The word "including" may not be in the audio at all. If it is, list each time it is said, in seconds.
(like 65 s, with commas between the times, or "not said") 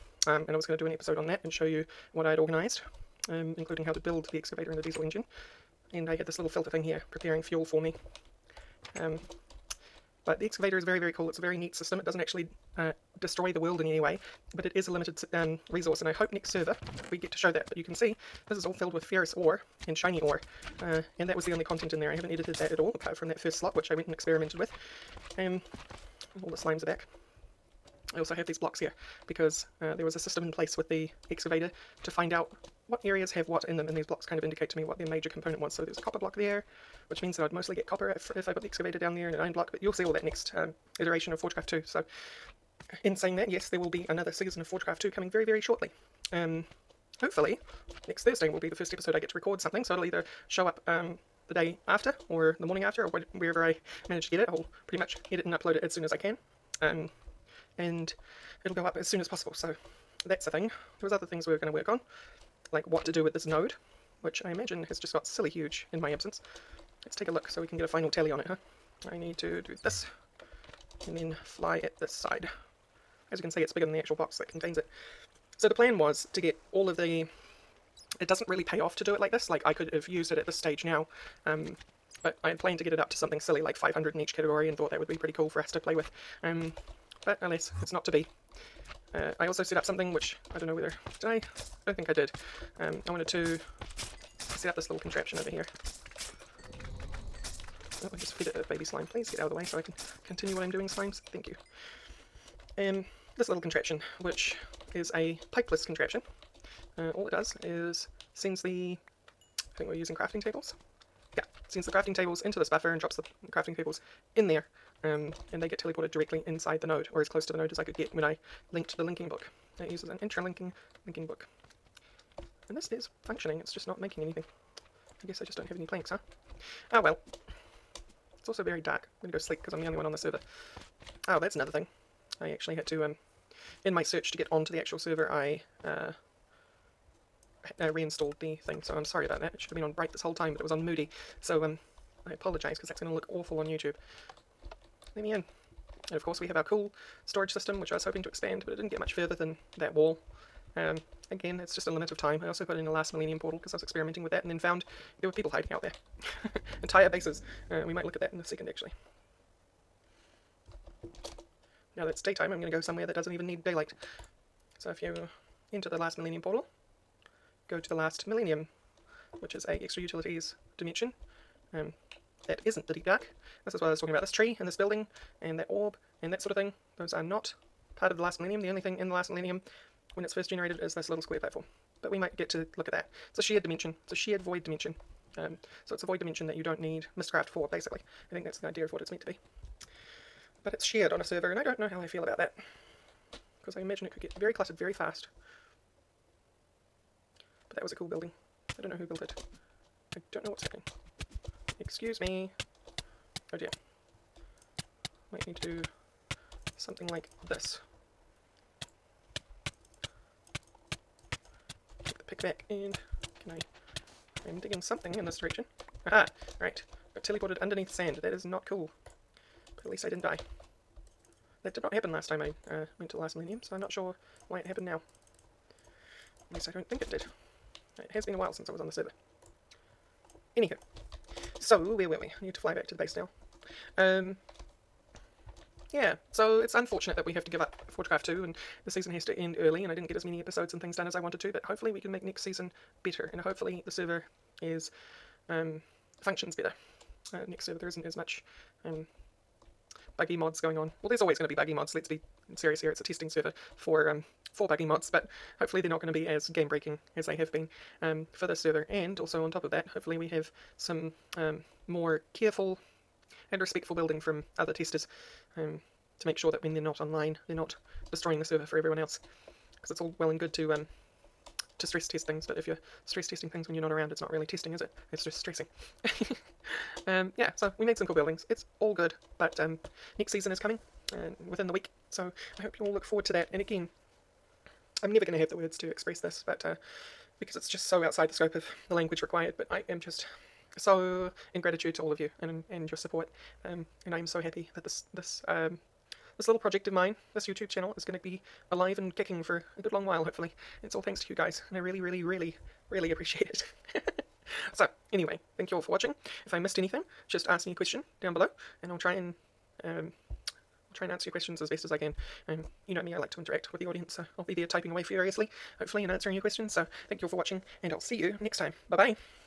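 3 s.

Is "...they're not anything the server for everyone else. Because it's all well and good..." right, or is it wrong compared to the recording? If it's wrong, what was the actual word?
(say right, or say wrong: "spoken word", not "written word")
wrong: "destroying", not "anything".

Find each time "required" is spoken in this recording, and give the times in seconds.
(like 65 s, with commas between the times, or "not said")
289 s.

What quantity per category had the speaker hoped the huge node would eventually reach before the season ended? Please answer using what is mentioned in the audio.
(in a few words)
500.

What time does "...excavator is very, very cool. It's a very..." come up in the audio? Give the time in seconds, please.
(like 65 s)
10 s.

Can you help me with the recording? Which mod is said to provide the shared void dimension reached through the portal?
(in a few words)
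Extra Utilities.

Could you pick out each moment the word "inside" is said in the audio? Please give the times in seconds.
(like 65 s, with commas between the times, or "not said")
116 s.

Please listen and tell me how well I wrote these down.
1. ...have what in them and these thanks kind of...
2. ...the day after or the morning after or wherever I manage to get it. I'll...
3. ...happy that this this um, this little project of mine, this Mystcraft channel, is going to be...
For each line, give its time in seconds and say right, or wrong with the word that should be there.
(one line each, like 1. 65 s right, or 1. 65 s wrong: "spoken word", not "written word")
1. 33 s wrong: "blocks", not "thanks"
2. 51 s right
3. 294 s wrong: "YouTube", not "Mystcraft".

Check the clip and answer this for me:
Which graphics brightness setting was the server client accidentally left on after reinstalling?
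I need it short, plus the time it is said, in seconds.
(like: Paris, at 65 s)
moody, at 140 s.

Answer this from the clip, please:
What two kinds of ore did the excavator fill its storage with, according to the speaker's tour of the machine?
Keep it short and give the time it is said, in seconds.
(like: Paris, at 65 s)
ferrous ore and shiny ore, at 19 s.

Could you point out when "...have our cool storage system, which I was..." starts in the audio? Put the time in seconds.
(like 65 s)
146 s.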